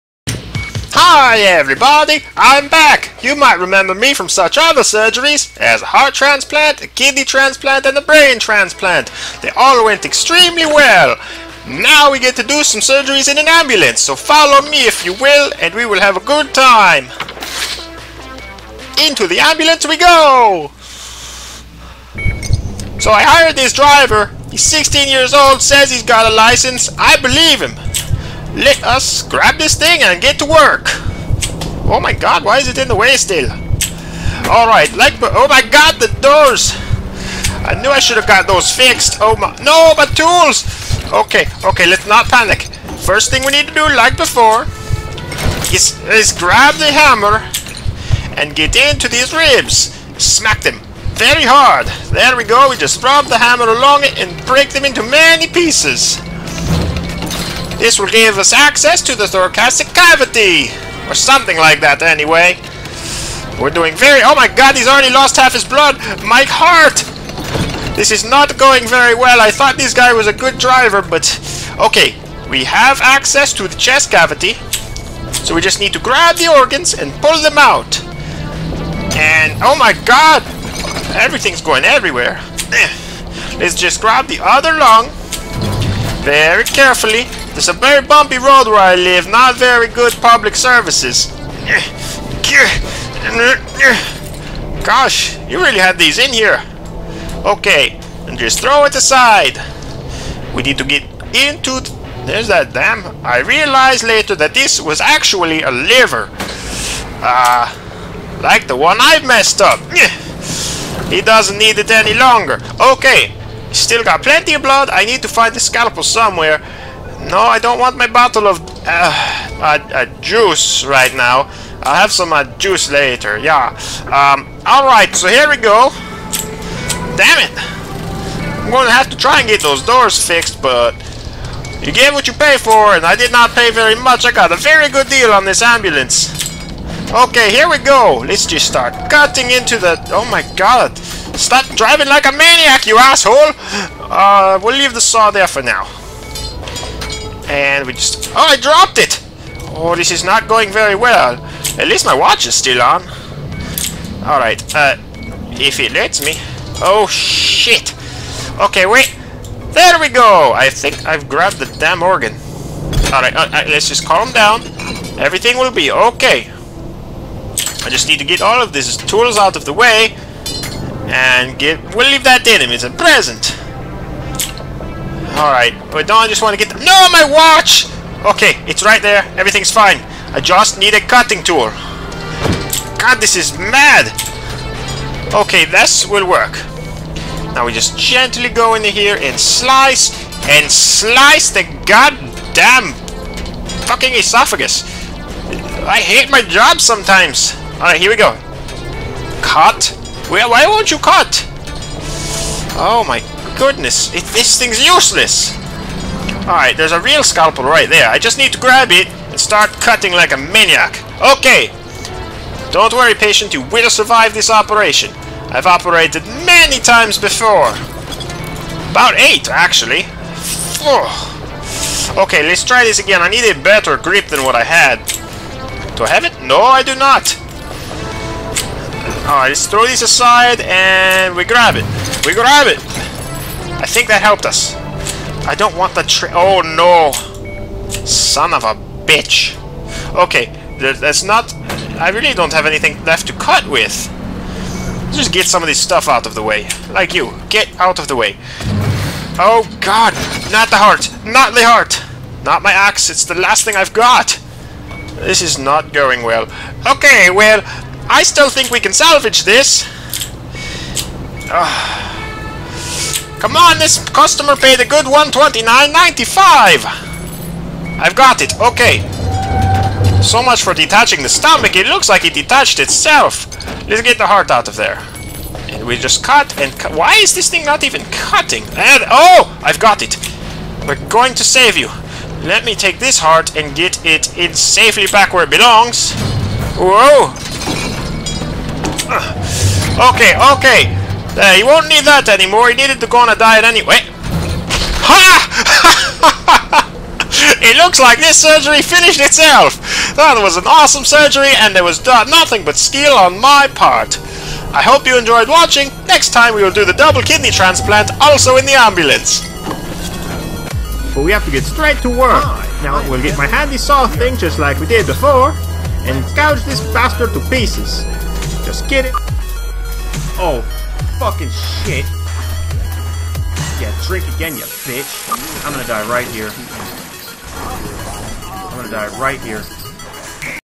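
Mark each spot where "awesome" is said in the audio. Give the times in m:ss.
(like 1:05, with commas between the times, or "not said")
5:00.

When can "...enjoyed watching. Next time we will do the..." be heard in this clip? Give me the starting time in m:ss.
5:05.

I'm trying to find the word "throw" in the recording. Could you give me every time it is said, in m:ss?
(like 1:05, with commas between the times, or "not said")
1:38, 3:49.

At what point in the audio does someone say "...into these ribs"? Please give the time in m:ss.
0:48.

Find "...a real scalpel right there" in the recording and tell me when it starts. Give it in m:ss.
3:26.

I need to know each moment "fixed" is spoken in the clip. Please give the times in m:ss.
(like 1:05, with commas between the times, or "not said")
0:38, 2:10.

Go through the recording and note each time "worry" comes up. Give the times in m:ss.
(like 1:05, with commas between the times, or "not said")
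3:32.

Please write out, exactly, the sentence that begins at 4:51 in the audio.
There, you won't need that anymore.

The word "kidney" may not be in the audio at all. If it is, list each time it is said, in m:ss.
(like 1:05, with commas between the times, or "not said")
0:06, 5:07.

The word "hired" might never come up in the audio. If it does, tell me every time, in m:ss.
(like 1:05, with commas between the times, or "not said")
0:23.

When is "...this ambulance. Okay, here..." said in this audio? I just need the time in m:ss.
2:15.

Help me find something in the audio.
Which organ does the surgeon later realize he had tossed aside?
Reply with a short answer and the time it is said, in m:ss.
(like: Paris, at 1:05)
liver, at 1:45.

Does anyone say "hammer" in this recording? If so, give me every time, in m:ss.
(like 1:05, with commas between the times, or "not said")
0:46, 0:53.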